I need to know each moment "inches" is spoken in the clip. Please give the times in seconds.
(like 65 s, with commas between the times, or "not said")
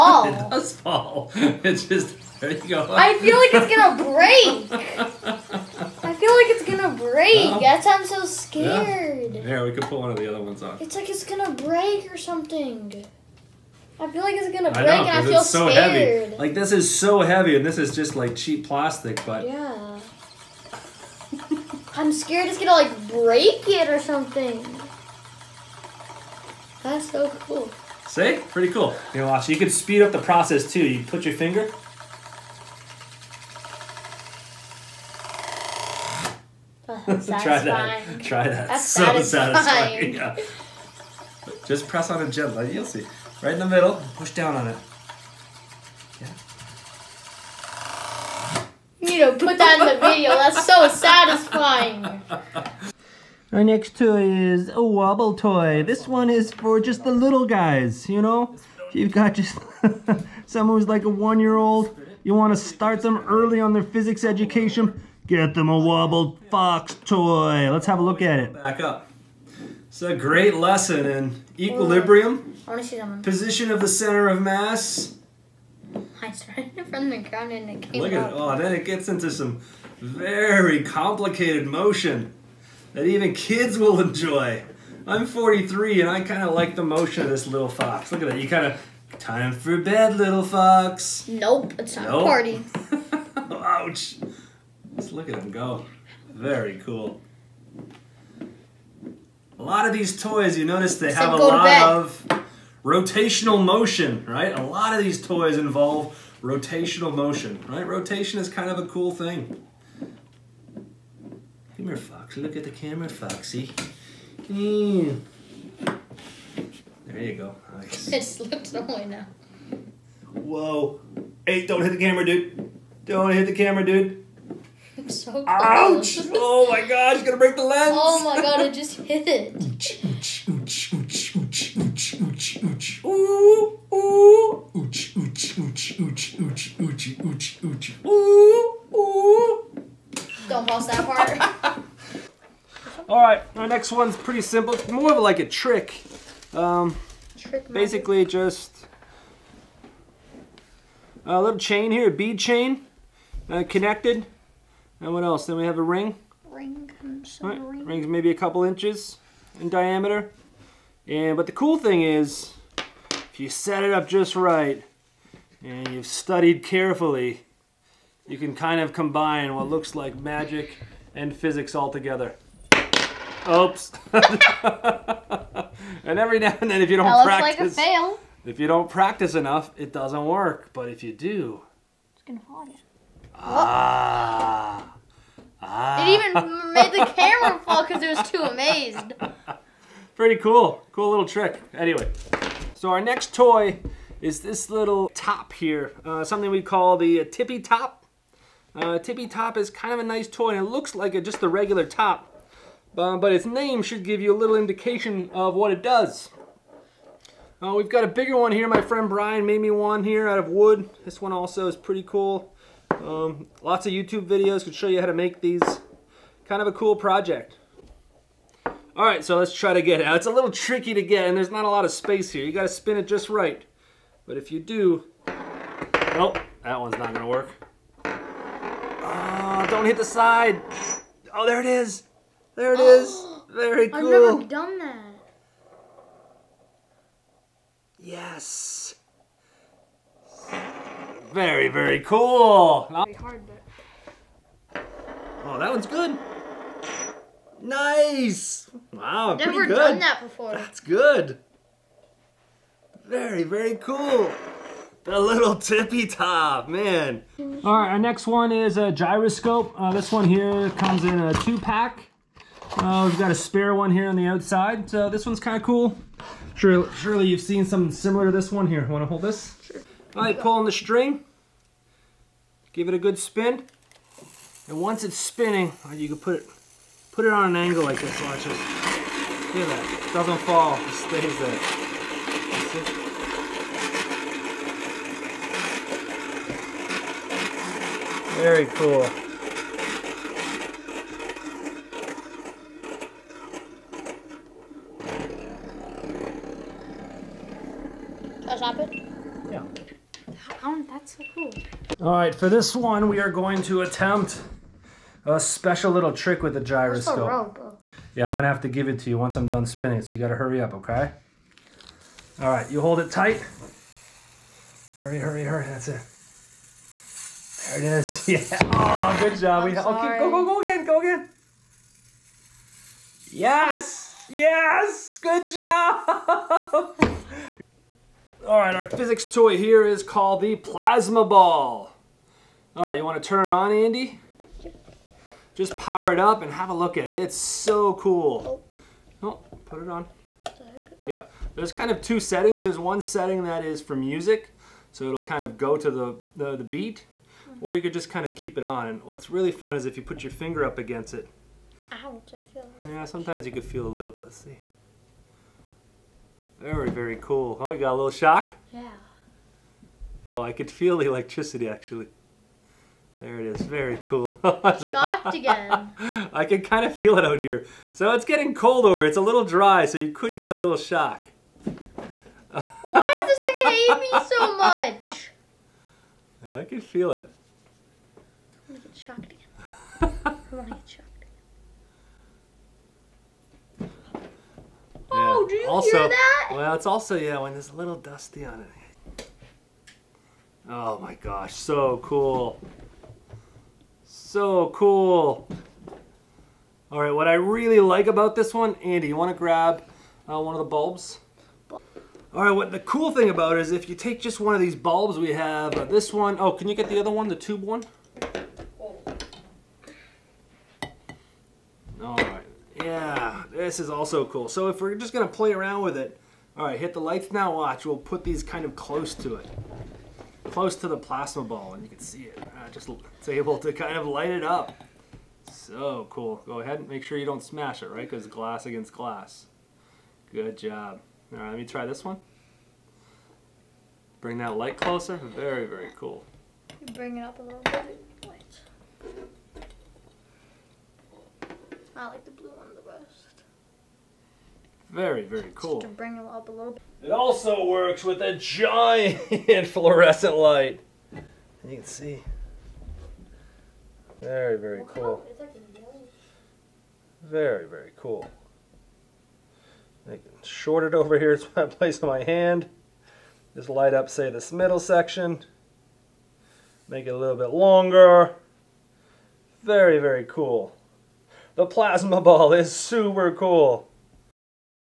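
158 s.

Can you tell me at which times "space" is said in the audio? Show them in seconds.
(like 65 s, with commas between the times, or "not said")
221 s.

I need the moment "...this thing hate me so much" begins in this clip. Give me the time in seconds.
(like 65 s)
373 s.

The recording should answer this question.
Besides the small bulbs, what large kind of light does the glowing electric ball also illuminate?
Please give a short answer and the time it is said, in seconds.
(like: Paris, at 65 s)
Fluorescent light, at 449 s.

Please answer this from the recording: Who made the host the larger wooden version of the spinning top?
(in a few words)
Brian.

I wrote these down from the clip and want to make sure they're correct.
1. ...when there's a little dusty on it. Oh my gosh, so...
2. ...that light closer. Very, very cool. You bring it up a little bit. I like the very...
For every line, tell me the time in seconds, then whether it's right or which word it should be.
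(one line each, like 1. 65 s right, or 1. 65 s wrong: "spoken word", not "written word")
1. 387 s right
2. 434 s right.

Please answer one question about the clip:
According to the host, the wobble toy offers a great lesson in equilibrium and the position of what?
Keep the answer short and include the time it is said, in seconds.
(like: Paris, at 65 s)
Center of mass, at 73 s.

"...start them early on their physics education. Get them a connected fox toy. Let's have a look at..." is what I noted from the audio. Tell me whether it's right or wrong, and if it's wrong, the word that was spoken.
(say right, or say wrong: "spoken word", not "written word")
wrong: "wobbled", not "connected".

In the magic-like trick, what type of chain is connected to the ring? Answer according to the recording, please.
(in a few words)
Bead chain.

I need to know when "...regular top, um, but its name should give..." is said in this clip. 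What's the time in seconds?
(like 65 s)
201 s.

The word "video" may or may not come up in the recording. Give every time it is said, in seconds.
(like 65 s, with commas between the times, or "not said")
50 s, 214 s.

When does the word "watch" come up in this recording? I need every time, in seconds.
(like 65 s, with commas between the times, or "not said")
29 s, 278 s, 417 s.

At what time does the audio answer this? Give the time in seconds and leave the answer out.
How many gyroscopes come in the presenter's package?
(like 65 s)
261 s.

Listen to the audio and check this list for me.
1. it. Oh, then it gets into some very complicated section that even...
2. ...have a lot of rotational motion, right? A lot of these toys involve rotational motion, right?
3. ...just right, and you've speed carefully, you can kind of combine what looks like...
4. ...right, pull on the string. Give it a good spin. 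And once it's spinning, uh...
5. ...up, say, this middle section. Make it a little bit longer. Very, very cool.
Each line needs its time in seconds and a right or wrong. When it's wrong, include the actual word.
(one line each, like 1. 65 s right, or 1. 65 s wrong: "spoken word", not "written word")
1. 78 s wrong: "motion", not "section"
2. 101 s right
3. 164 s wrong: "studied", not "speed"
4. 270 s right
5. 463 s right.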